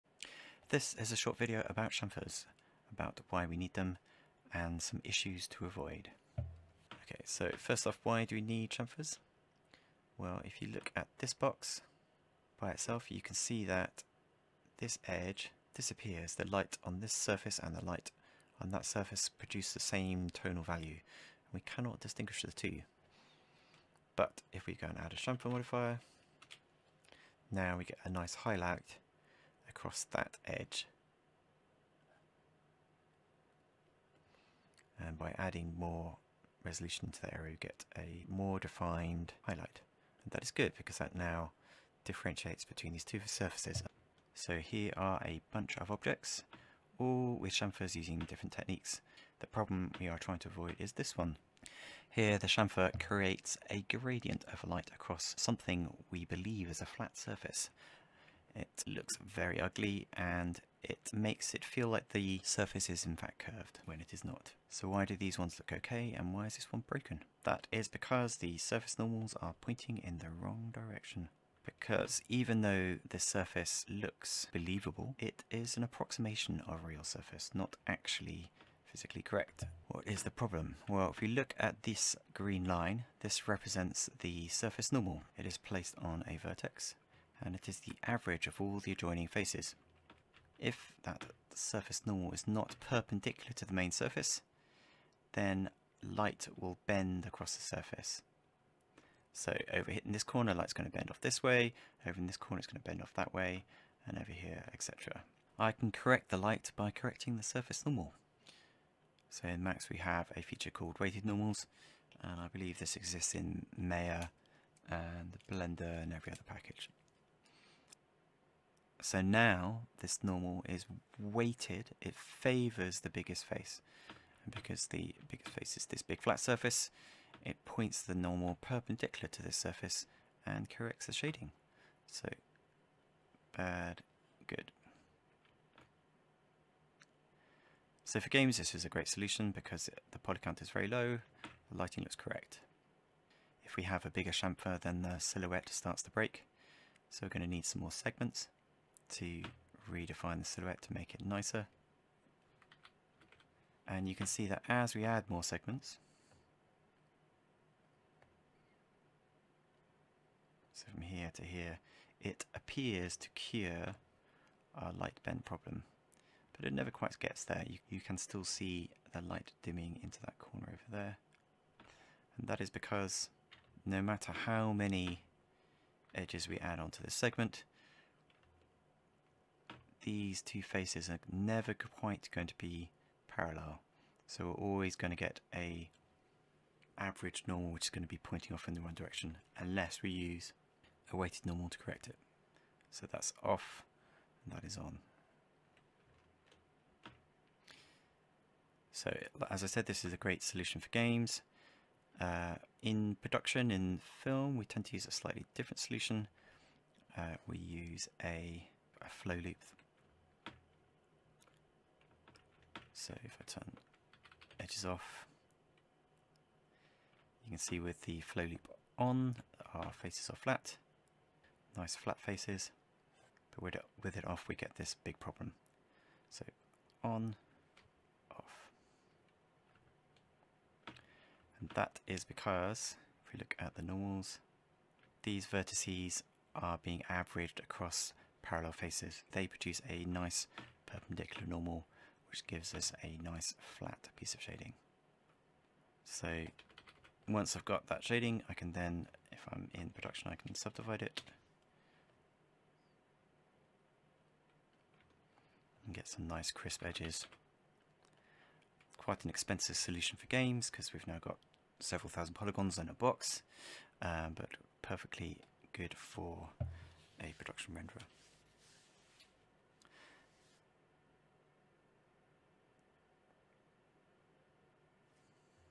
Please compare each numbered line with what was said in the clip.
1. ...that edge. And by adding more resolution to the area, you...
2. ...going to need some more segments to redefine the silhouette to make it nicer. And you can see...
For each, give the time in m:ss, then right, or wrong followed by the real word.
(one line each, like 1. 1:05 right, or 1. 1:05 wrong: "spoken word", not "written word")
1. 0:30 right
2. 2:27 right.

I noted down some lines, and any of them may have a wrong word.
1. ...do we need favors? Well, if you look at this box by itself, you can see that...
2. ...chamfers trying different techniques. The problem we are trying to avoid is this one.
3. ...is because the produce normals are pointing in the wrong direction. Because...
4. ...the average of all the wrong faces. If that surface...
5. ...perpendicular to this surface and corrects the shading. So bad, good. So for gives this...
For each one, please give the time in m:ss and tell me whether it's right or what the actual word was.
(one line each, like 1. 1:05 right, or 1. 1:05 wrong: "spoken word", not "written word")
1. 0:08 wrong: "chamfers", not "favors"
2. 0:47 wrong: "using", not "trying"
3. 1:07 wrong: "surface", not "produce"
4. 1:27 wrong: "adjoining", not "wrong"
5. 2:08 wrong: "games", not "gives".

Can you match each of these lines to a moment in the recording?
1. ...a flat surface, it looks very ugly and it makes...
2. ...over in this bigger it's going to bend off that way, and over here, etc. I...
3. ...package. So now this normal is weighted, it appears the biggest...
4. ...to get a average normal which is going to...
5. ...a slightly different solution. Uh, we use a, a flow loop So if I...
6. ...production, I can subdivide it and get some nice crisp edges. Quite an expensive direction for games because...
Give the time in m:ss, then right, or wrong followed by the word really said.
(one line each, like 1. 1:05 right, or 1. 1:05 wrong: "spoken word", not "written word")
1. 0:56 right
2. 1:42 wrong: "corner", not "bigger"
3. 1:56 wrong: "favors", not "appears"
4. 3:05 right
5. 3:25 right
6. 4:09 wrong: "solution", not "direction".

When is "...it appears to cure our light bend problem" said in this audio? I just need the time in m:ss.
2:42.